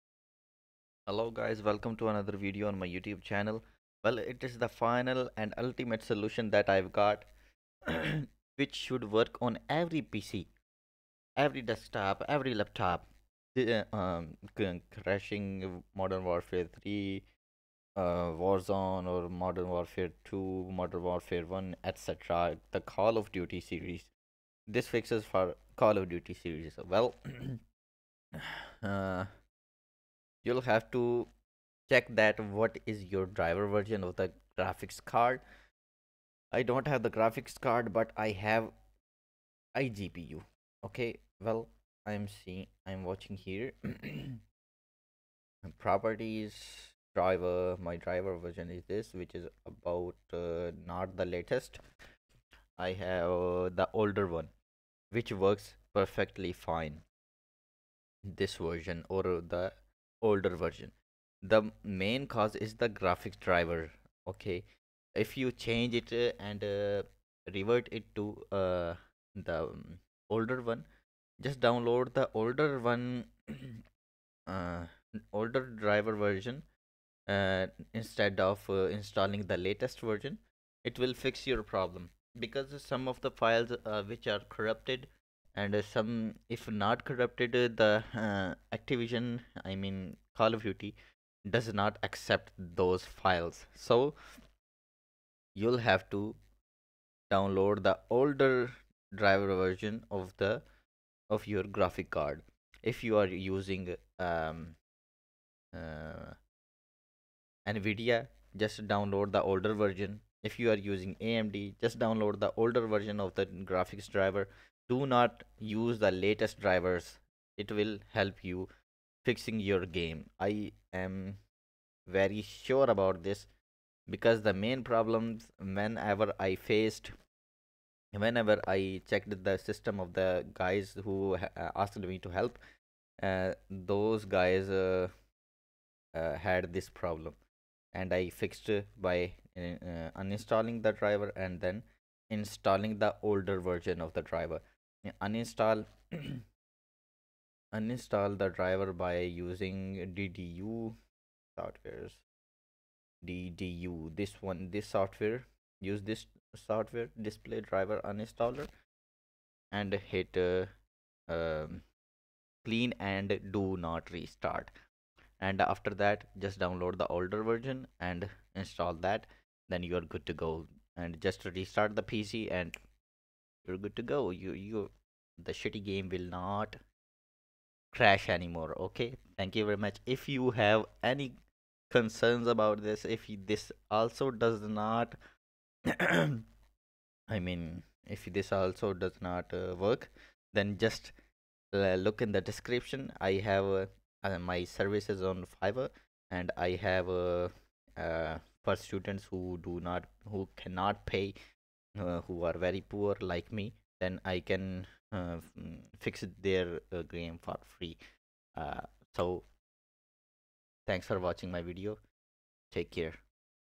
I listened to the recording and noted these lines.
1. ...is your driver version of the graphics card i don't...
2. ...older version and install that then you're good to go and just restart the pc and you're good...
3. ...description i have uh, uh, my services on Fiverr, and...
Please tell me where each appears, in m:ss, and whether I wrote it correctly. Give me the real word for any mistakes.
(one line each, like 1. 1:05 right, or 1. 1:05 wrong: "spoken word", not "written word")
1. 0:32 right
2. 2:47 right
3. 3:12 right.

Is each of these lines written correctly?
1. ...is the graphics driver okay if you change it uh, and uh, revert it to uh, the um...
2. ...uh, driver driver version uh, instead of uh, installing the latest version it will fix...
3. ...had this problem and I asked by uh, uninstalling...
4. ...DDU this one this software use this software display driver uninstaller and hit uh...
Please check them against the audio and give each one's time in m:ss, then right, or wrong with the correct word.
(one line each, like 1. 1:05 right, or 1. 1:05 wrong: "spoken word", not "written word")
1. 1:02 right
2. 1:14 wrong: "older", not "driver"
3. 2:16 wrong: "fixed", not "asked"
4. 2:33 right.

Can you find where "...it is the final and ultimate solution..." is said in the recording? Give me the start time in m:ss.
0:04.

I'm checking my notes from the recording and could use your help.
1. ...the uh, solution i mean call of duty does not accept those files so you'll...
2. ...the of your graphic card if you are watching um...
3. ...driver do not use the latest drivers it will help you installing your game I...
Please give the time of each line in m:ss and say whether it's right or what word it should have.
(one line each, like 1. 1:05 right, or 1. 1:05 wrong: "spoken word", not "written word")
1. 1:27 wrong: "activision", not "solution"
2. 1:40 wrong: "using", not "watching"
3. 1:54 wrong: "fixing", not "installing".